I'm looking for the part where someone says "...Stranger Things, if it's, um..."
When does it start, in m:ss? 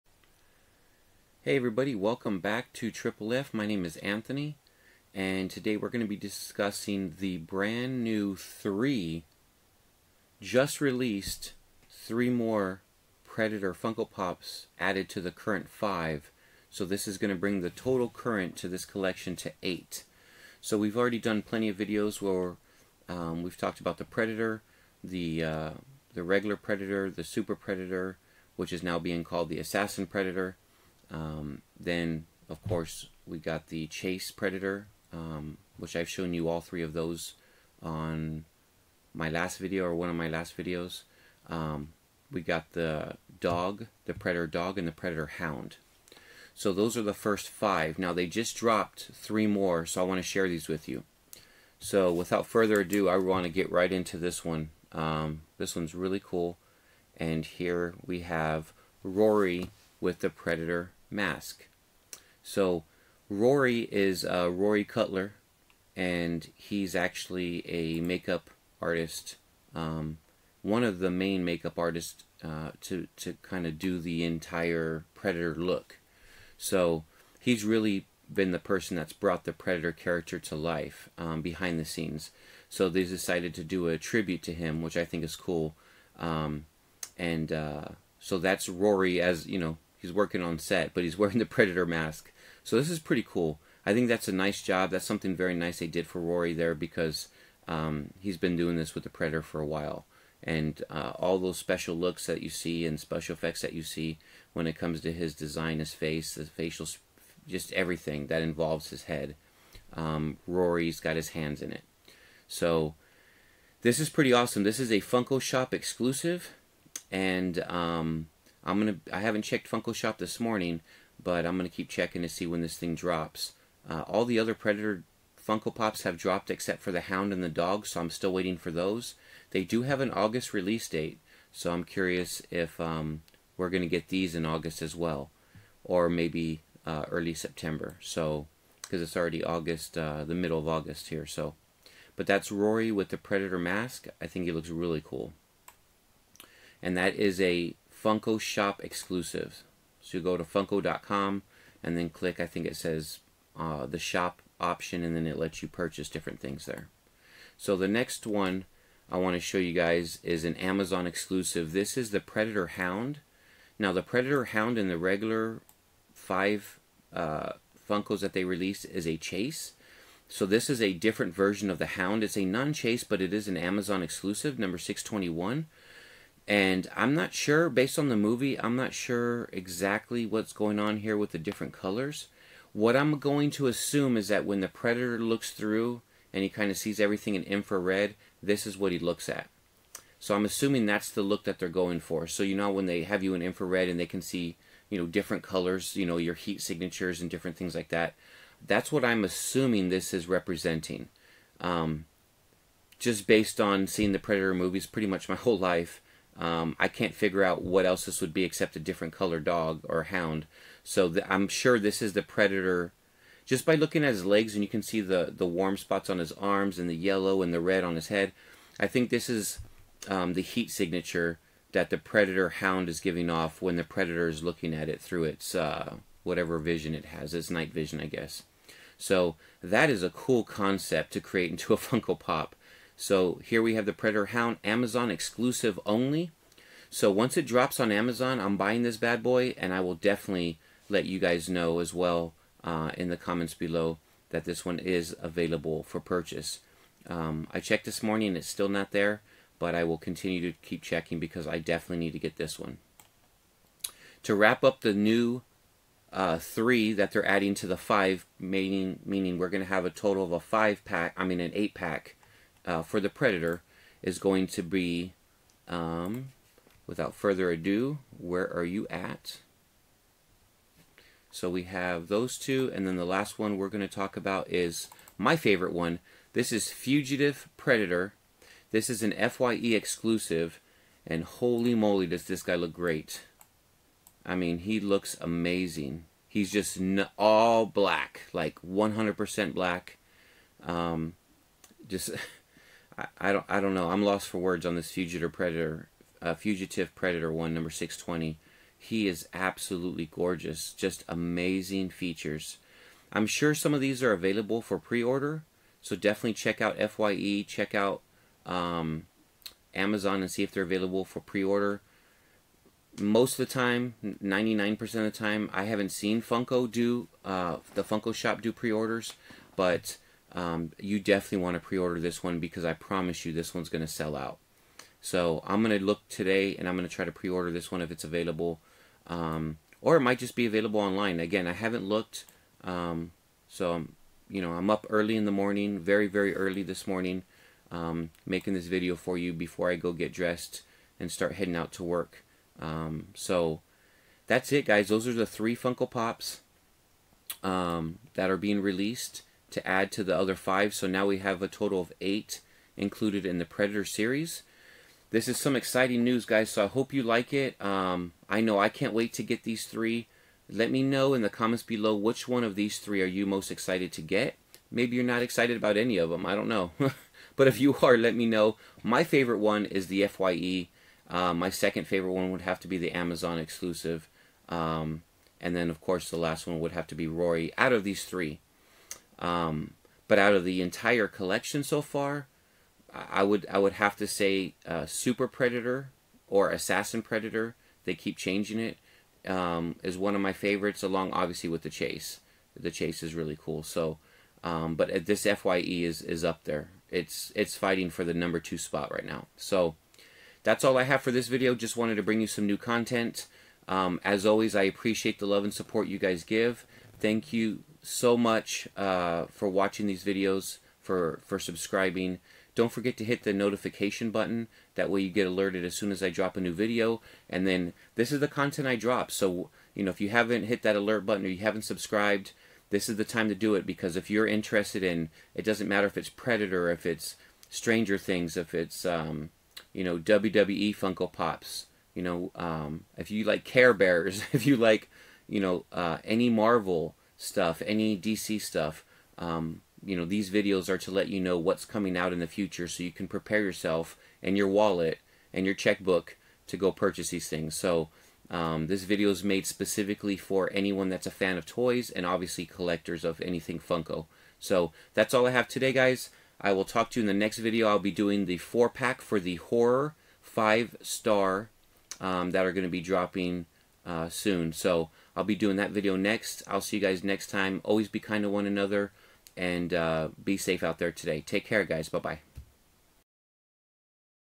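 7:07.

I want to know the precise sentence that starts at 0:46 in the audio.
So those are the first five.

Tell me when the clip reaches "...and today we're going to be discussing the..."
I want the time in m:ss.
0:05.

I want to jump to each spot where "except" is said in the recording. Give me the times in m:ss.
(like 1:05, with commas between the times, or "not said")
2:06, 3:28.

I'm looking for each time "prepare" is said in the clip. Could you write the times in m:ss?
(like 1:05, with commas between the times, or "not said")
7:23.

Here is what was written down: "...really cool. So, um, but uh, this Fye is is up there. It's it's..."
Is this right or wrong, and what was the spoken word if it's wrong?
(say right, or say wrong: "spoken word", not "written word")
right.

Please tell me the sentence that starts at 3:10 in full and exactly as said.
So I'm assuming that's the look that they're going for.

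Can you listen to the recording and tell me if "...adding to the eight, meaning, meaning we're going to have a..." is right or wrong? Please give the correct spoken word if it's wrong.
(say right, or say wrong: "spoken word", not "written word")
wrong: "five", not "eight".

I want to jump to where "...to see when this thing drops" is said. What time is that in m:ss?
2:02.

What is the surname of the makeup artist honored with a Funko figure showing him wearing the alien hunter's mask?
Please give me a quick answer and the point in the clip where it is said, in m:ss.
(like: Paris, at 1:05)
Cutler, at 1:04.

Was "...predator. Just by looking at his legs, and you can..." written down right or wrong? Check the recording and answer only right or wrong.
right.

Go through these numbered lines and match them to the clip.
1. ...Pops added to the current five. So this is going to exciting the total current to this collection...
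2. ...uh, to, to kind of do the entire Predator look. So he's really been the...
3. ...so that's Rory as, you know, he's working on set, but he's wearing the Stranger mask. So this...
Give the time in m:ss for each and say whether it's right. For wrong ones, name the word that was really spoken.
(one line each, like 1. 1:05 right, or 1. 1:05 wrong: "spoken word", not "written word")
1. 0:14 wrong: "bring", not "exciting"
2. 1:12 right
3. 1:28 wrong: "Predator", not "Stranger".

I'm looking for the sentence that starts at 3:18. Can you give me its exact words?
That's what I'm assuming this is representing.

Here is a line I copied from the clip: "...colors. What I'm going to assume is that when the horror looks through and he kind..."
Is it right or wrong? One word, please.
wrong.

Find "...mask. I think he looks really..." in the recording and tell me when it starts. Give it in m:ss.
2:23.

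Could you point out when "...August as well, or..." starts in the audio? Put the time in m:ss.
2:14.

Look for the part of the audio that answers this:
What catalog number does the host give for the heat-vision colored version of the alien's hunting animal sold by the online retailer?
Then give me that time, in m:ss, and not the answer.
2:54.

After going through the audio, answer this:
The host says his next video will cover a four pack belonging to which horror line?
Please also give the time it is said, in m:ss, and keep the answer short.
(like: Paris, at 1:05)
horror five star, at 7:39.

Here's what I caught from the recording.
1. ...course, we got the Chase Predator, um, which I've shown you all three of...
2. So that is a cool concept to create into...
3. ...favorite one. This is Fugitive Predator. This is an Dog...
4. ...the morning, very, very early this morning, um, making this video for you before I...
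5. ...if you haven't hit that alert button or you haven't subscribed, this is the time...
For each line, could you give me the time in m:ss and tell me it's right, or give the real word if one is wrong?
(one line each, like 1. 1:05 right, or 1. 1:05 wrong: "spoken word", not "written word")
1. 0:32 right
2. 3:48 right
3. 4:35 wrong: "FYE", not "Dog"
4. 5:35 right
5. 6:59 right.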